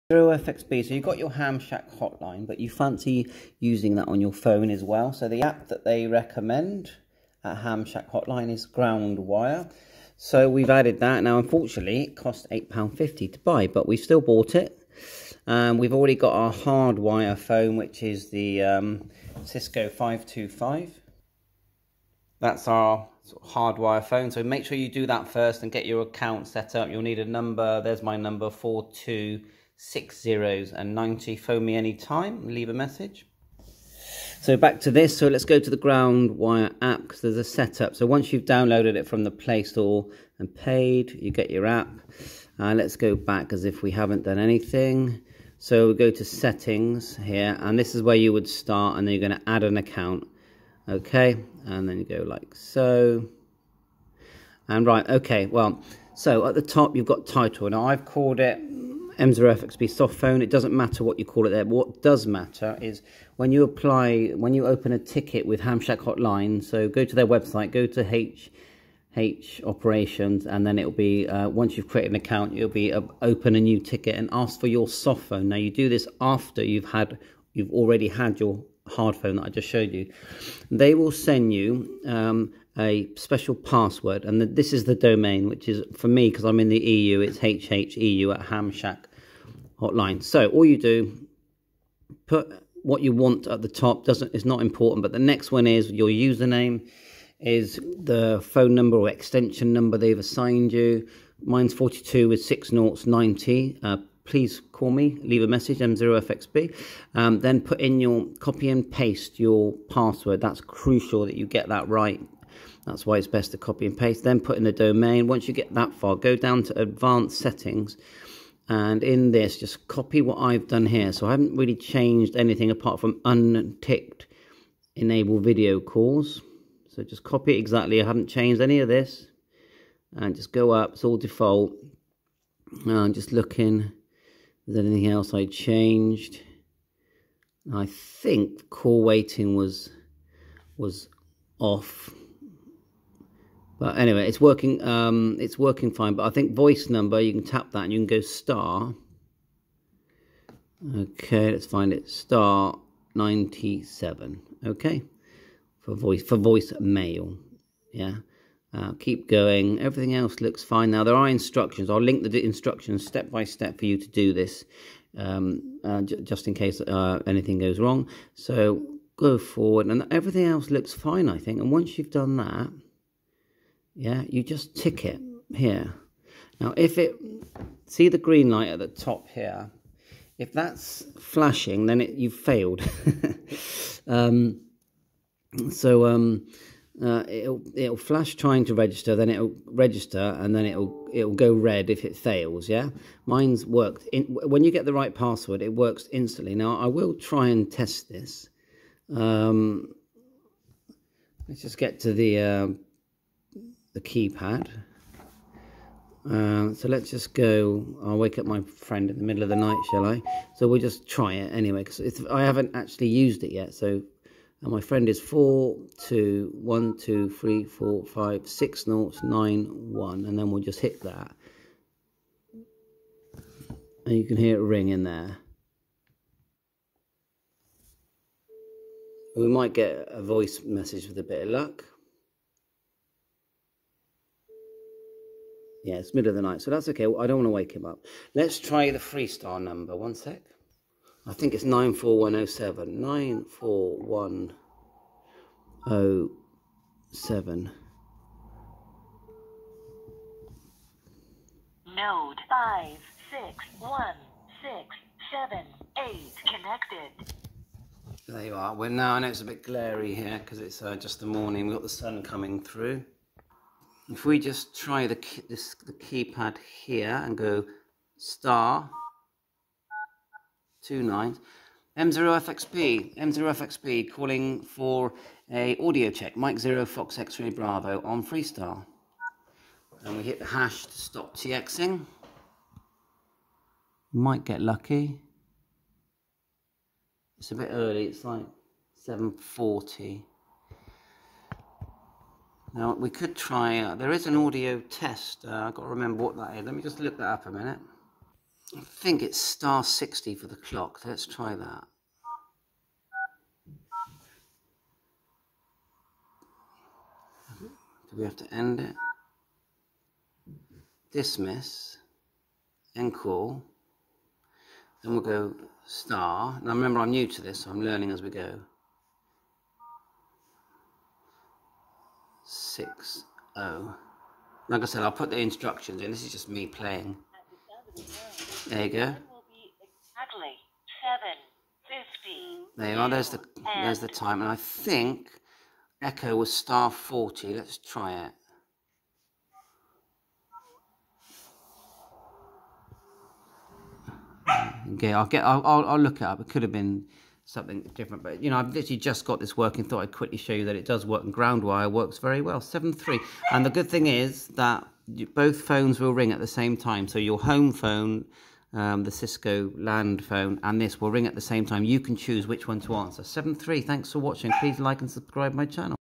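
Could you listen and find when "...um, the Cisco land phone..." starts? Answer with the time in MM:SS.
05:58.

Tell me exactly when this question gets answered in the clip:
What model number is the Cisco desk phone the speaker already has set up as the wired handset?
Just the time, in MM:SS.
00:19.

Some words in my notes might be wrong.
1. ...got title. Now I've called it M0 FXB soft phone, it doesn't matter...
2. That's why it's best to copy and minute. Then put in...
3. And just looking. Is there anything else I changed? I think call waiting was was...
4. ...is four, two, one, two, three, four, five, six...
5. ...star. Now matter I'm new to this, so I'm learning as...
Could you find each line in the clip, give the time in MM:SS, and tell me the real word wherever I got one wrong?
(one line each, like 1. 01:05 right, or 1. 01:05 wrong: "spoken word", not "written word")
1. 00:57 right
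2. 01:52 wrong: "paste", not "minute"
3. 02:12 right
4. 03:35 right
5. 05:15 wrong: "remember", not "matter".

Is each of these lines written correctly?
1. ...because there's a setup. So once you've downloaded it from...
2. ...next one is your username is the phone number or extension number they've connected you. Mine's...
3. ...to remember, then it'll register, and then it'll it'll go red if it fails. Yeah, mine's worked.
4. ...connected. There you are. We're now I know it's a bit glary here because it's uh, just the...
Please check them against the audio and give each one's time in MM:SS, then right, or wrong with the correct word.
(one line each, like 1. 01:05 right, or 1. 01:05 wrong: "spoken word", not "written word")
1. 00:37 right
2. 01:35 wrong: "assigned", not "connected"
3. 03:08 wrong: "register", not "remember"
4. 04:16 right.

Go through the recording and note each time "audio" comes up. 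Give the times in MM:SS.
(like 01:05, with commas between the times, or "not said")
04:35, 04:54.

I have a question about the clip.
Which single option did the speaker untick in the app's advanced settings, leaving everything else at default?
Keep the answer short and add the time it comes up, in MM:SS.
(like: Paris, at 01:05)
Enable video calls, at 02:04.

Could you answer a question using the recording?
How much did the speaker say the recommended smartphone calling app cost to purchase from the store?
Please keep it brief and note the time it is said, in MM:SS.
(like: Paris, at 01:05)
£8.50, at 00:12.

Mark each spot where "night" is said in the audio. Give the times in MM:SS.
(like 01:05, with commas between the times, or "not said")
03:29, 03:56.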